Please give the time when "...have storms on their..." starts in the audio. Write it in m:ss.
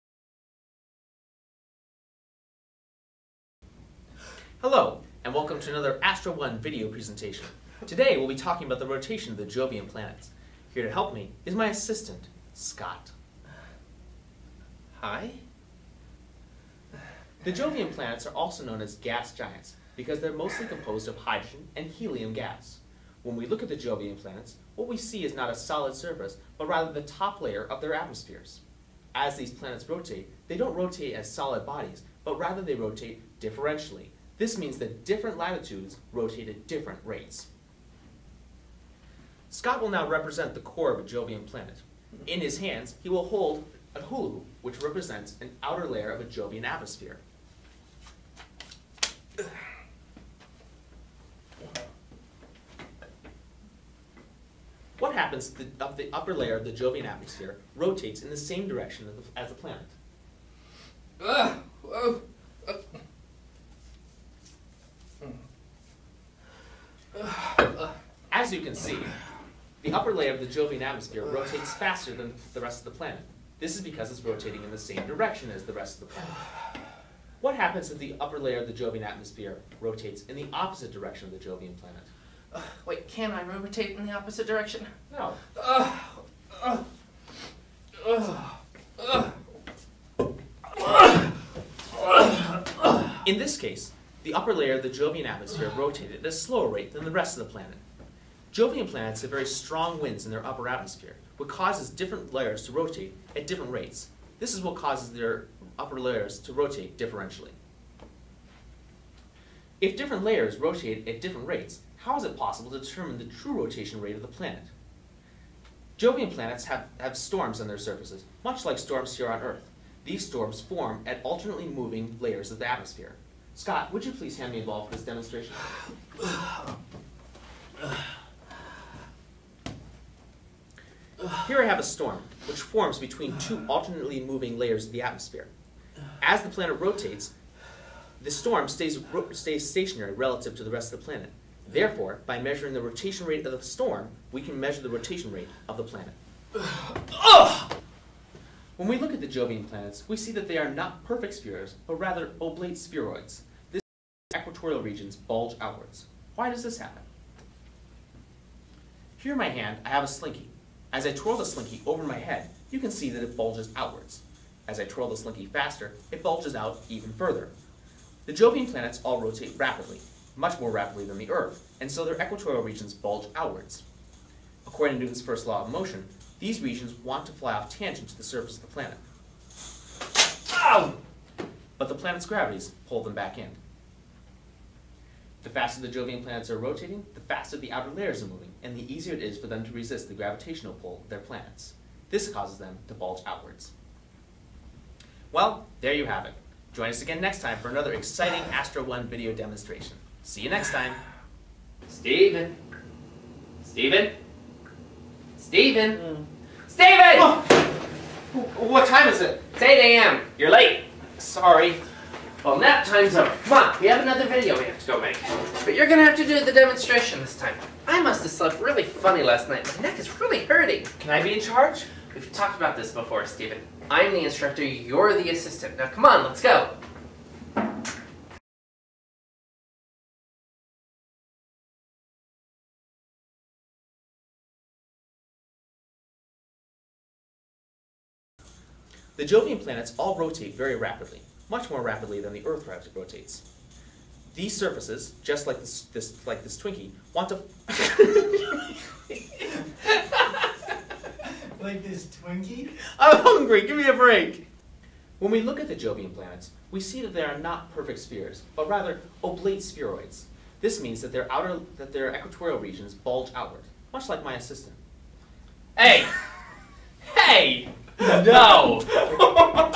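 1:56.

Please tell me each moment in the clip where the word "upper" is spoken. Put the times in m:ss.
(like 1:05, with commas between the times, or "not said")
0:56, 1:09, 1:18, 1:34, 1:40, 1:45.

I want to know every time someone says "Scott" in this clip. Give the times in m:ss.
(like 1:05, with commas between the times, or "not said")
0:12, 0:39, 2:03.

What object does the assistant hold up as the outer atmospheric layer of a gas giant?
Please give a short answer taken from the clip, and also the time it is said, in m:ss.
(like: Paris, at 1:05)
hulu, at 0:43.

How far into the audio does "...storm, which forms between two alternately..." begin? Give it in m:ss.
2:11.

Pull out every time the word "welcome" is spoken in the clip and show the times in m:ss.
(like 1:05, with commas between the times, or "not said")
0:05.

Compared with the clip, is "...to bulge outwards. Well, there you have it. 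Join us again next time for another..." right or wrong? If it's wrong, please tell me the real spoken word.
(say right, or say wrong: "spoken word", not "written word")
right.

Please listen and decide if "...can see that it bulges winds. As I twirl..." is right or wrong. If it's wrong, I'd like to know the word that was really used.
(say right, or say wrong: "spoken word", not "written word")
wrong: "outwards", not "winds".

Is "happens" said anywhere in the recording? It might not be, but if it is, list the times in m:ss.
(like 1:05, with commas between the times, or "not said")
0:55, 1:17, 2:36.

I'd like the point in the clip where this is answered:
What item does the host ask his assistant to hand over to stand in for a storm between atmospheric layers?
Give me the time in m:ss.
2:04.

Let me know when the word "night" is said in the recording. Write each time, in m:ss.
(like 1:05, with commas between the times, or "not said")
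3:39.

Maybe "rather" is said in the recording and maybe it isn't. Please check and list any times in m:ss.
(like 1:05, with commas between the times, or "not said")
0:26, 0:32, 2:31, 4:18.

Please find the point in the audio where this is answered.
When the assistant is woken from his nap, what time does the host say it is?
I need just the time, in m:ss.
3:29.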